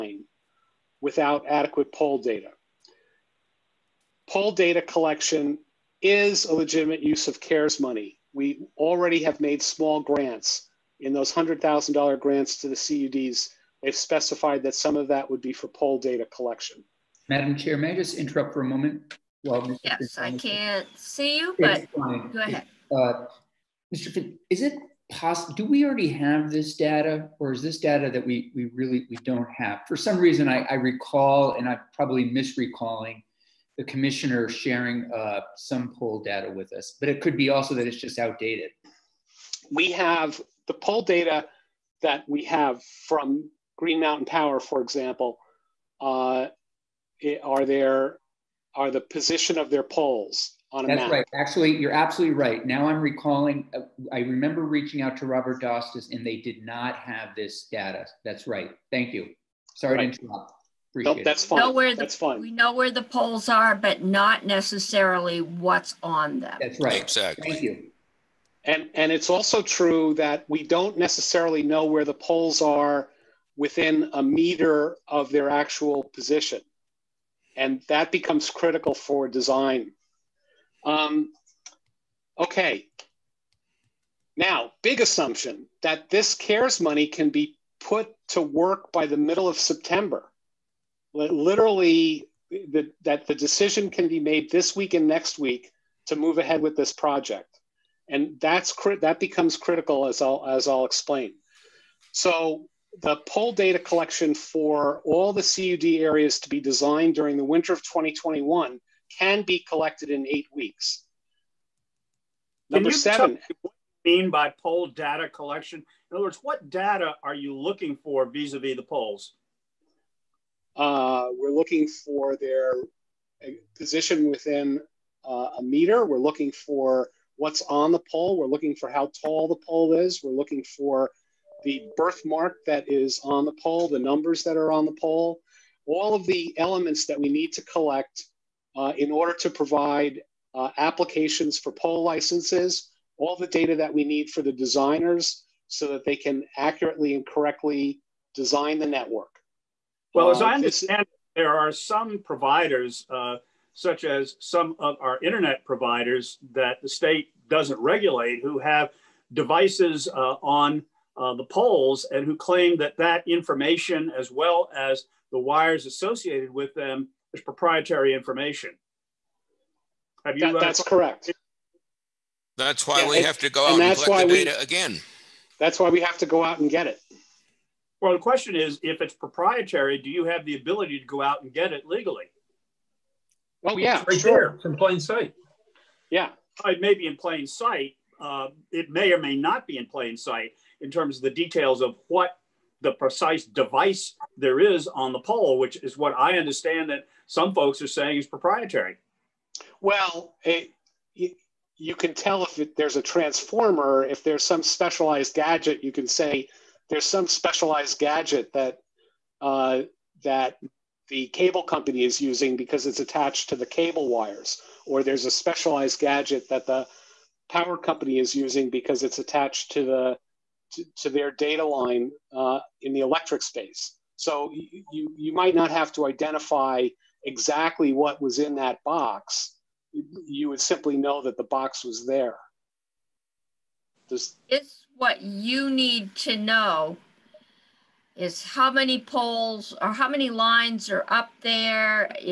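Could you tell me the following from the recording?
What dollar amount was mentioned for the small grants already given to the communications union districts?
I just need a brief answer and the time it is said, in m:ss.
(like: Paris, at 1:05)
$100,000, at 0:11.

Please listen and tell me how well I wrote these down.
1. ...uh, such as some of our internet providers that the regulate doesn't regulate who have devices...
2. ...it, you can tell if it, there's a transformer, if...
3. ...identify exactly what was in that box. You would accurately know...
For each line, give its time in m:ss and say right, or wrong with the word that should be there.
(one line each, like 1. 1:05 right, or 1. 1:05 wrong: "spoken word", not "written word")
1. 2:33 wrong: "state", not "regulate"
2. 3:20 right
3. 3:46 wrong: "simply", not "accurately".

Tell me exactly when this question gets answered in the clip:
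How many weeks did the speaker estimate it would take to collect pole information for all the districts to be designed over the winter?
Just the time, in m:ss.
1:50.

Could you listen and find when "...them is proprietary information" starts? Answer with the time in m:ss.
2:46.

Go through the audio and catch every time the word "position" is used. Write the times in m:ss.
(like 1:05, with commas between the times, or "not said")
0:49, 1:16, 2:03.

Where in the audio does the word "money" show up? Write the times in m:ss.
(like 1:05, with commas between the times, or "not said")
0:07, 1:26.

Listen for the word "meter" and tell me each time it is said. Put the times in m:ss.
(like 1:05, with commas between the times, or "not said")
1:14, 2:05.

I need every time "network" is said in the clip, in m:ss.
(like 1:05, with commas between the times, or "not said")
2:28.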